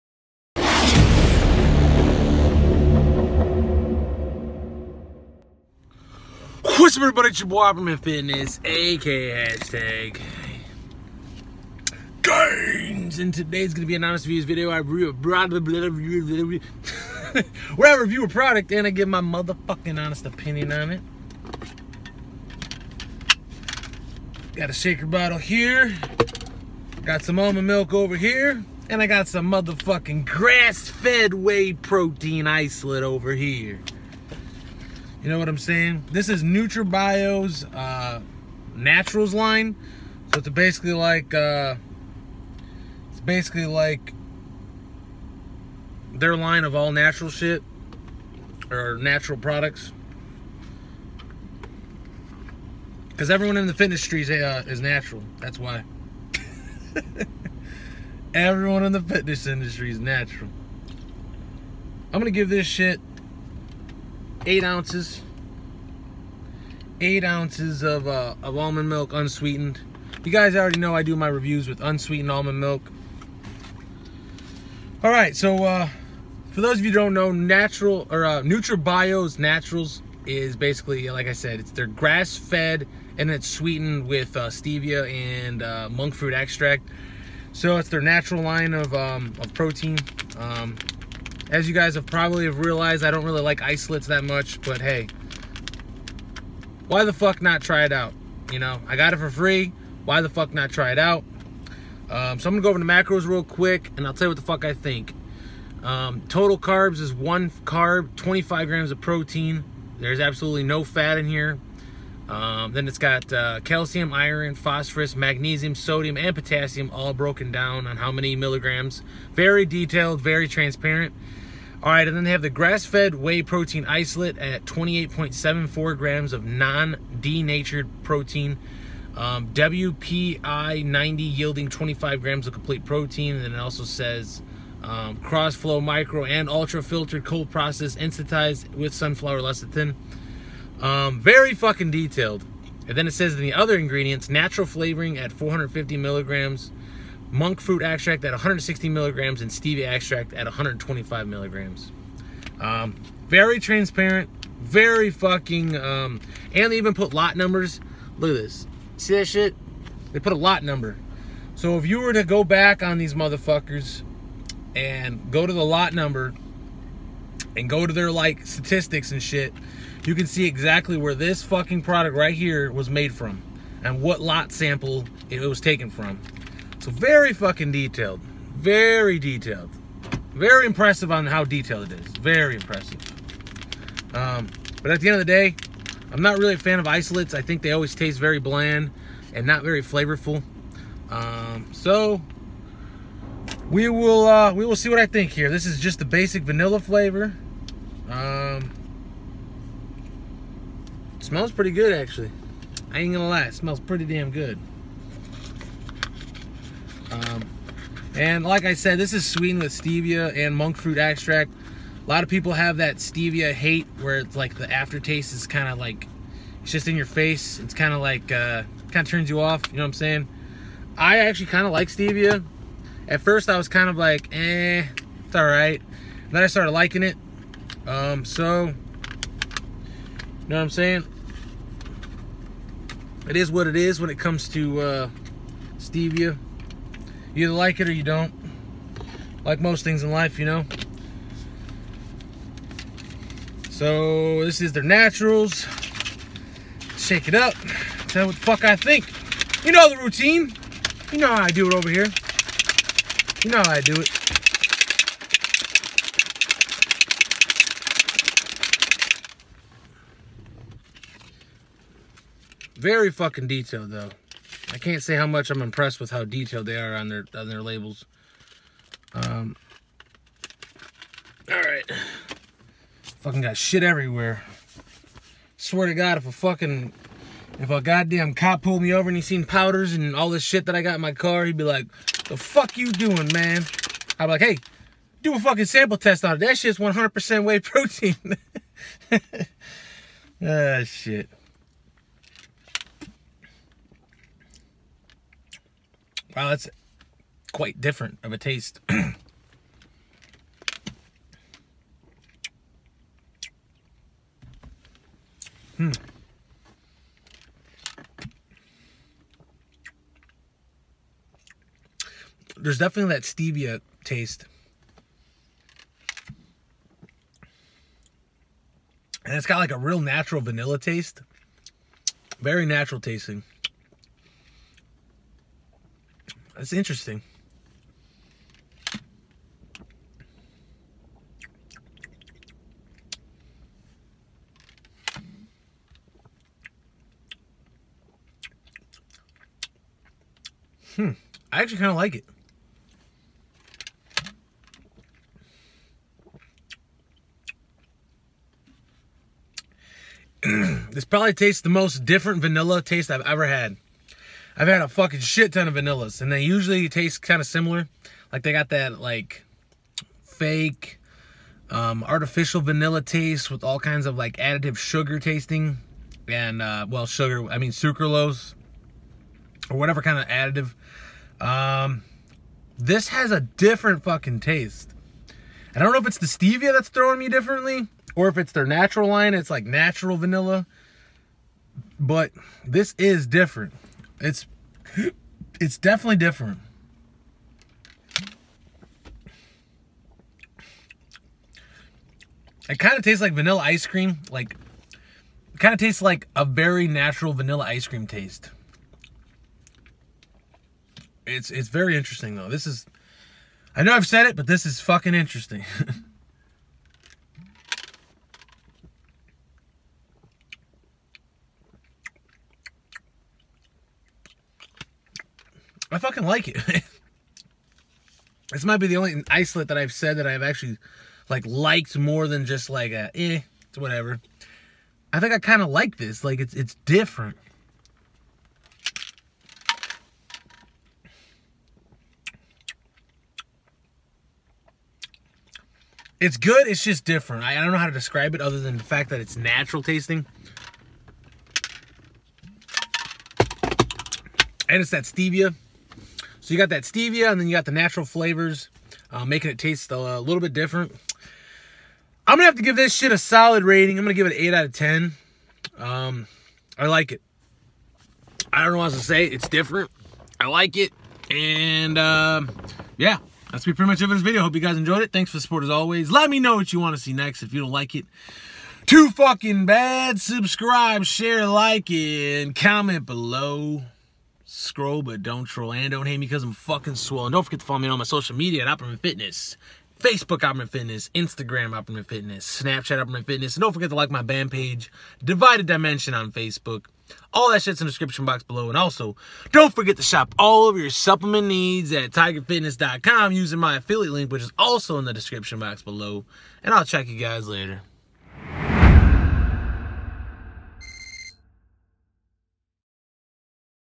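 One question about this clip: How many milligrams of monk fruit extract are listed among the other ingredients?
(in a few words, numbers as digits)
160.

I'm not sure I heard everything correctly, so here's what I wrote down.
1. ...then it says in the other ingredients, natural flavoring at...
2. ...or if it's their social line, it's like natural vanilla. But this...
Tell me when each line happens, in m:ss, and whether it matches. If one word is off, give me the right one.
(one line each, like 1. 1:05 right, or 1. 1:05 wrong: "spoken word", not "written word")
1. 2:22 right
2. 6:18 wrong: "natural", not "social".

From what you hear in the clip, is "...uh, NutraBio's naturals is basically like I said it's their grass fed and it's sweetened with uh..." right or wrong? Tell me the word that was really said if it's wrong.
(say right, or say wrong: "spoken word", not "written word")
right.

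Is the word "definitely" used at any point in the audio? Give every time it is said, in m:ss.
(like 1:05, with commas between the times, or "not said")
5:12, 6:25.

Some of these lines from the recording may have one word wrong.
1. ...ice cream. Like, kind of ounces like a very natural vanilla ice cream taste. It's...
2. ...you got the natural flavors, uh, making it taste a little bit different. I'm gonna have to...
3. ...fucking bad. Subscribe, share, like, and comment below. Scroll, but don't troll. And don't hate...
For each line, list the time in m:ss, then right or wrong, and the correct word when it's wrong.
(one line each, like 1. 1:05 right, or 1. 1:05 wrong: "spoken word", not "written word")
1. 6:33 wrong: "tastes", not "ounces"
2. 7:27 right
3. 7:49 right.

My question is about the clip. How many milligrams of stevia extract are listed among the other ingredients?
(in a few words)
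125.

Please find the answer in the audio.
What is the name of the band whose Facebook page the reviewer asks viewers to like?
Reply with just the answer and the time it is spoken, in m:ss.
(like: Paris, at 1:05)
Divided Dimension, at 8:05.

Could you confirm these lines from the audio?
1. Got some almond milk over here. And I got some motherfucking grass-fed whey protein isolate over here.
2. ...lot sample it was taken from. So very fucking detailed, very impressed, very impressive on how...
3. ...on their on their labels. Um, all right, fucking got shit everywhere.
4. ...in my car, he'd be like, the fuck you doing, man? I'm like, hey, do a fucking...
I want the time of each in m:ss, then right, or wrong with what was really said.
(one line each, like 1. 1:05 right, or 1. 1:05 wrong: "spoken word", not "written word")
1. 0:27 right
2. 2:54 wrong: "detailed", not "impressed"
3. 4:26 right
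4. 4:40 right.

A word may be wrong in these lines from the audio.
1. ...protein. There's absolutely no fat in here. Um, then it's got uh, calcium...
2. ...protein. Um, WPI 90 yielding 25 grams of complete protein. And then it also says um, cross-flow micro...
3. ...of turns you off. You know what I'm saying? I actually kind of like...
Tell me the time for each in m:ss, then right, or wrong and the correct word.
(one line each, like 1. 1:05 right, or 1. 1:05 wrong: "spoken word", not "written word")
1. 1:49 right
2. 2:08 right
3. 3:39 right.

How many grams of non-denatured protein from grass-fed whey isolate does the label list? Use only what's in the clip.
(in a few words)
28.74.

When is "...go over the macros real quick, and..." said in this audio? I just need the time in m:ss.
1:42.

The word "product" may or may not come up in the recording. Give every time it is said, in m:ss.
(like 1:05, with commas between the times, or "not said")
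0:18, 0:49, 2:51.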